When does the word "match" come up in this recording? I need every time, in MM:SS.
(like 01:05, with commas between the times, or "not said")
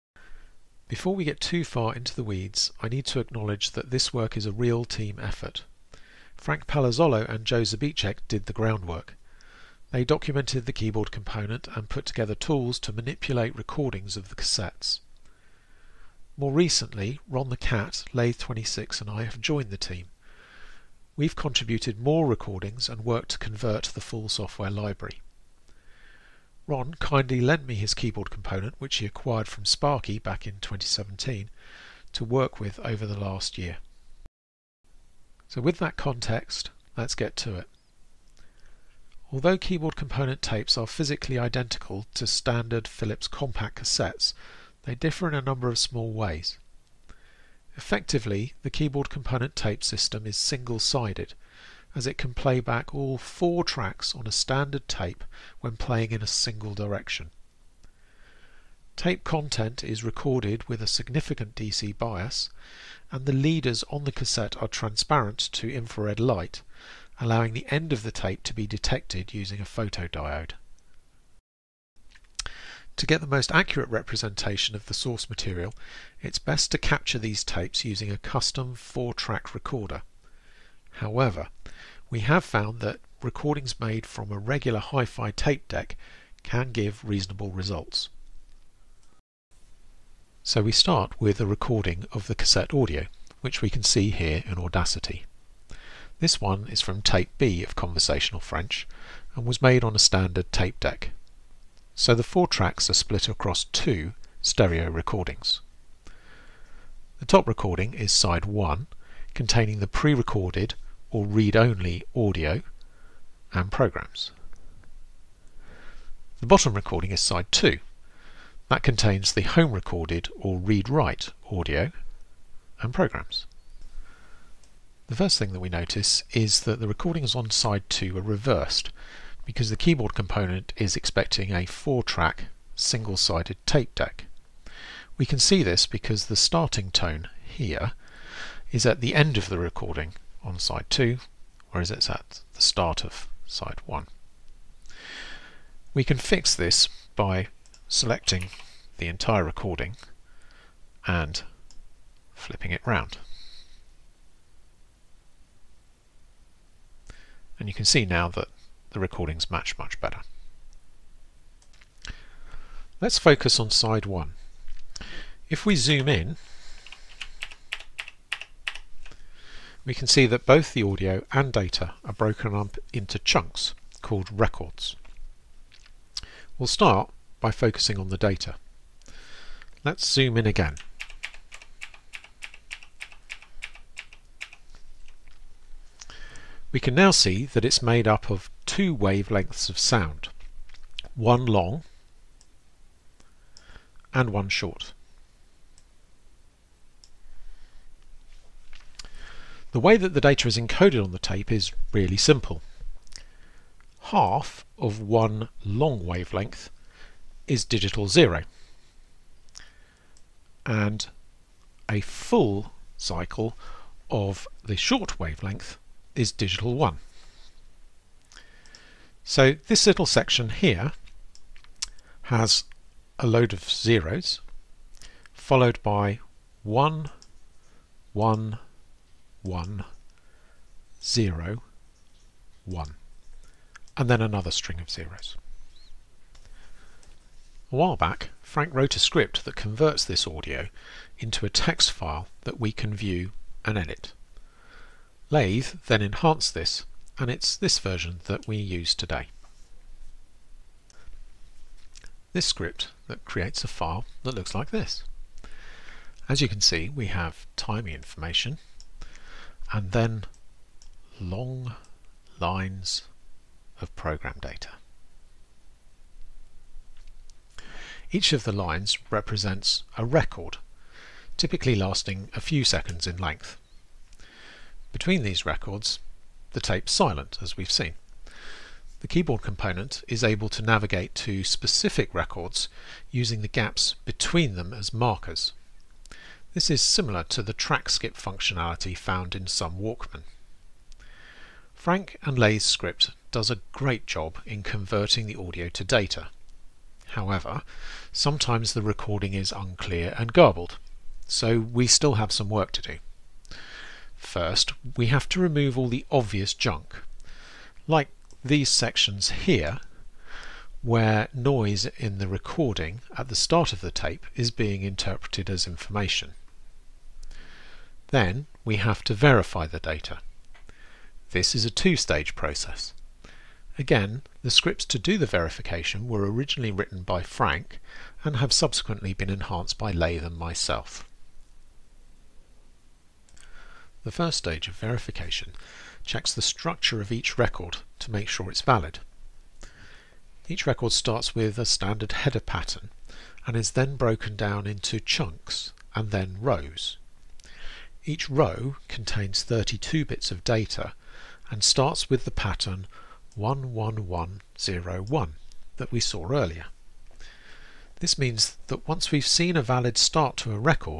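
02:39.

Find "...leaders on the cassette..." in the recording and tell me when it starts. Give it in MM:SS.
01:03.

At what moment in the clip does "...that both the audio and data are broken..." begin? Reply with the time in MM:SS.
02:50.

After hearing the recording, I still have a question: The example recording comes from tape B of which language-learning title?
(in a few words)
Conversational French.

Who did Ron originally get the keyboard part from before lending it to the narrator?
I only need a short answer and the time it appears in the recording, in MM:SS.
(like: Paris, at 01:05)
Sparky, at 00:29.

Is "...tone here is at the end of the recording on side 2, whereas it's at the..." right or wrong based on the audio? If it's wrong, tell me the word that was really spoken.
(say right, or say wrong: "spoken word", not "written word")
right.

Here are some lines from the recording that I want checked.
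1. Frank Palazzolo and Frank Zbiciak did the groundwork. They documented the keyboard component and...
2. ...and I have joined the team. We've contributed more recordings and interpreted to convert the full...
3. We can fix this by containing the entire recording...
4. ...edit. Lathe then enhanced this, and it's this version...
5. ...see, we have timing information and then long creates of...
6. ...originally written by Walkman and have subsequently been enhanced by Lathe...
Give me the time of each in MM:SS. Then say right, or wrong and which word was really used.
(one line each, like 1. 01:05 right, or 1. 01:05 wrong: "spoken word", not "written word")
1. 00:06 wrong: "Joe", not "Frank"
2. 00:18 wrong: "worked", not "interpreted"
3. 02:25 wrong: "selecting", not "containing"
4. 04:03 right
5. 04:16 wrong: "lines", not "creates"
6. 05:26 wrong: "Frank", not "Walkman".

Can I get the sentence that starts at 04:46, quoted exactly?
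This is similar to the track skip functionality found in some Walkman.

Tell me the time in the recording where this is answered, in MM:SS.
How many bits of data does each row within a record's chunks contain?
05:49.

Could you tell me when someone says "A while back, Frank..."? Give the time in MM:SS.
03:57.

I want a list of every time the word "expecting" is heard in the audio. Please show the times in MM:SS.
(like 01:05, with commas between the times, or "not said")
02:10.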